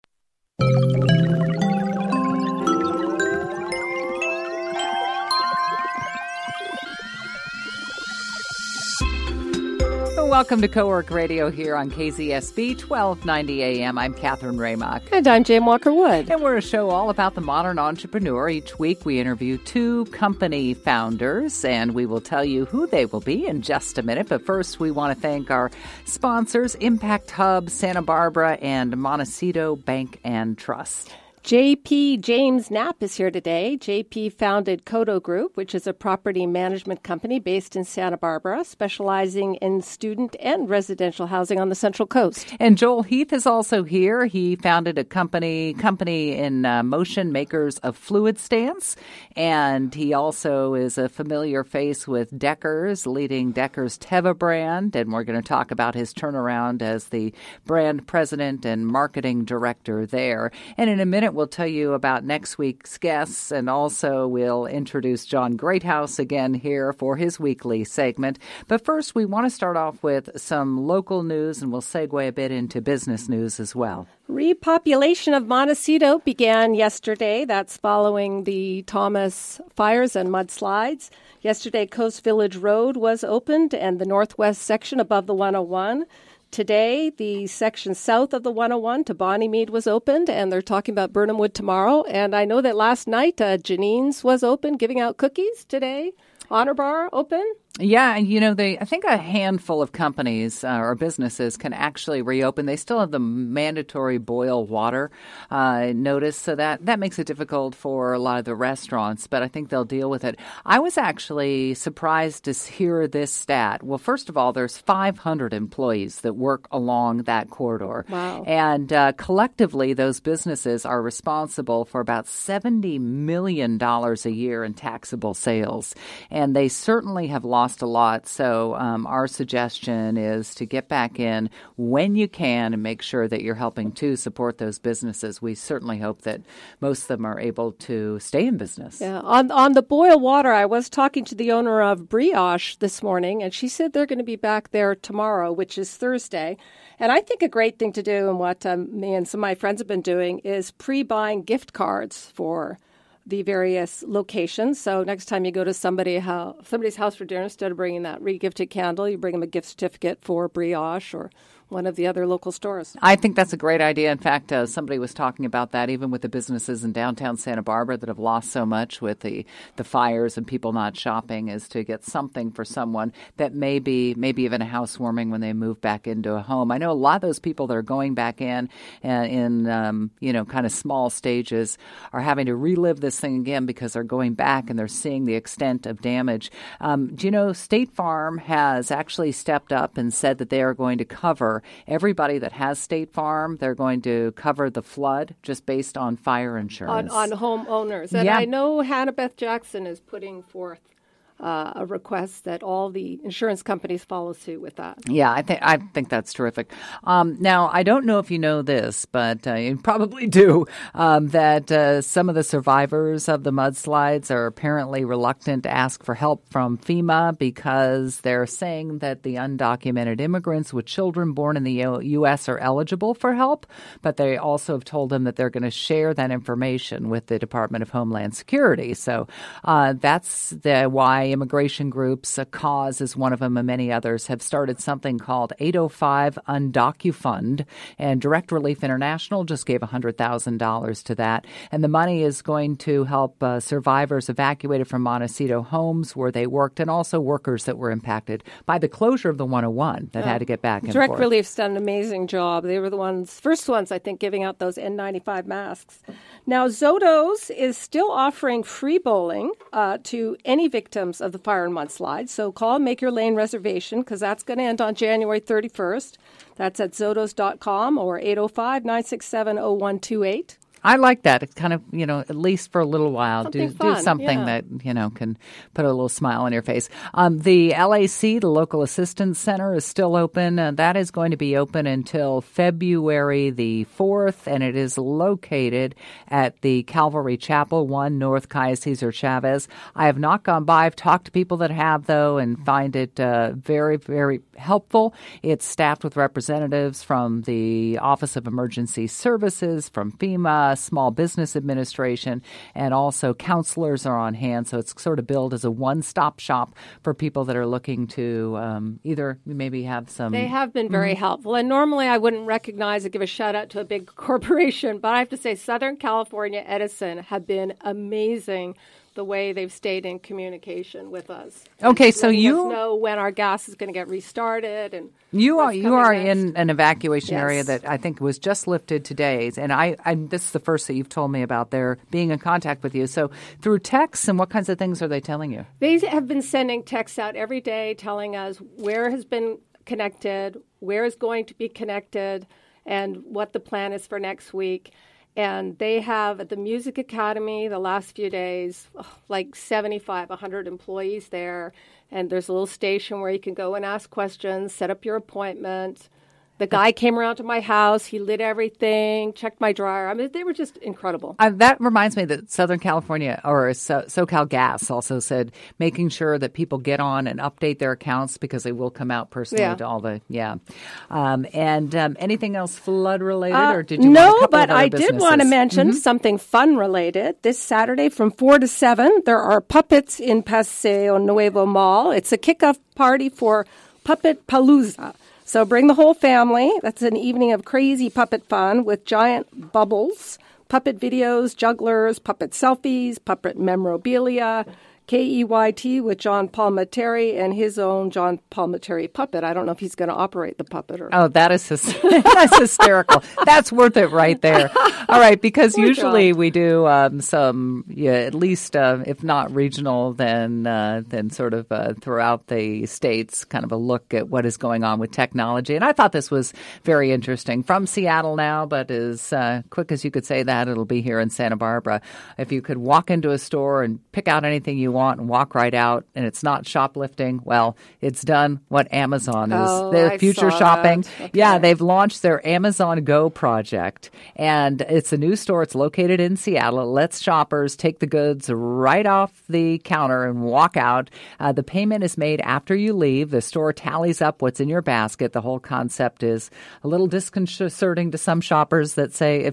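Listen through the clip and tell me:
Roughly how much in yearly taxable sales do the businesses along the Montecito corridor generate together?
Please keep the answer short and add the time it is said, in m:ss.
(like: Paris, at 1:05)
$70 million, at 2:02.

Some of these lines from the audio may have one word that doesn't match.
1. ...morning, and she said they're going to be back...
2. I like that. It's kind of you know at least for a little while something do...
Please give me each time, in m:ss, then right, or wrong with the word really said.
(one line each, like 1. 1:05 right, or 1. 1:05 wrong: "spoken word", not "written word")
1. 2:23 right
2. 4:30 right.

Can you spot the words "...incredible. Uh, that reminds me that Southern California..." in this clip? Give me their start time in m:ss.
6:00.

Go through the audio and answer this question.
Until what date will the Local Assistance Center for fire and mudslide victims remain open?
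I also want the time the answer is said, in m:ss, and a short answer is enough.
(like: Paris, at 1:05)
February 4, at 4:42.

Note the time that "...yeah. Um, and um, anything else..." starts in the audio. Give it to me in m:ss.
6:10.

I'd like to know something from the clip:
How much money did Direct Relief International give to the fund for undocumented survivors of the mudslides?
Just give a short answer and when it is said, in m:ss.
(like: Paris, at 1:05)
$100,000, at 3:59.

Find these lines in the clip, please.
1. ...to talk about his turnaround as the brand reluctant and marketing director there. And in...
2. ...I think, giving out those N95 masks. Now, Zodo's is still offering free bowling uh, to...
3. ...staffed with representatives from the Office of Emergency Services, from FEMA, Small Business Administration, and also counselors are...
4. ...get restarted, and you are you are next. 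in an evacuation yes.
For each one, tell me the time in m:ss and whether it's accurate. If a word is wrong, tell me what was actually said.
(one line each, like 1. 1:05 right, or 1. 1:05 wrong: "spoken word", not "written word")
1. 0:55 wrong: "president", not "reluctant"
2. 4:13 right
3. 4:55 right
4. 5:23 right.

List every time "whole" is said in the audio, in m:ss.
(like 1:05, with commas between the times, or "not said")
6:25, 7:25.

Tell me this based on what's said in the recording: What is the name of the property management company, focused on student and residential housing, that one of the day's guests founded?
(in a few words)
Koto Group.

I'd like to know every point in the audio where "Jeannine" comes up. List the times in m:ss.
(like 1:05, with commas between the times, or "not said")
1:33.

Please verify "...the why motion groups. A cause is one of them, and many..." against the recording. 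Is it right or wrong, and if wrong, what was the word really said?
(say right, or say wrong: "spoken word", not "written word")
wrong: "immigration", not "motion".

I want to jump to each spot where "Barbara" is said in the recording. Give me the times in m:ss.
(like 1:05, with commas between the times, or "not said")
0:28, 0:38, 2:47, 7:01.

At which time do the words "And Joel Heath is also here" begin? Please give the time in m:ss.
0:42.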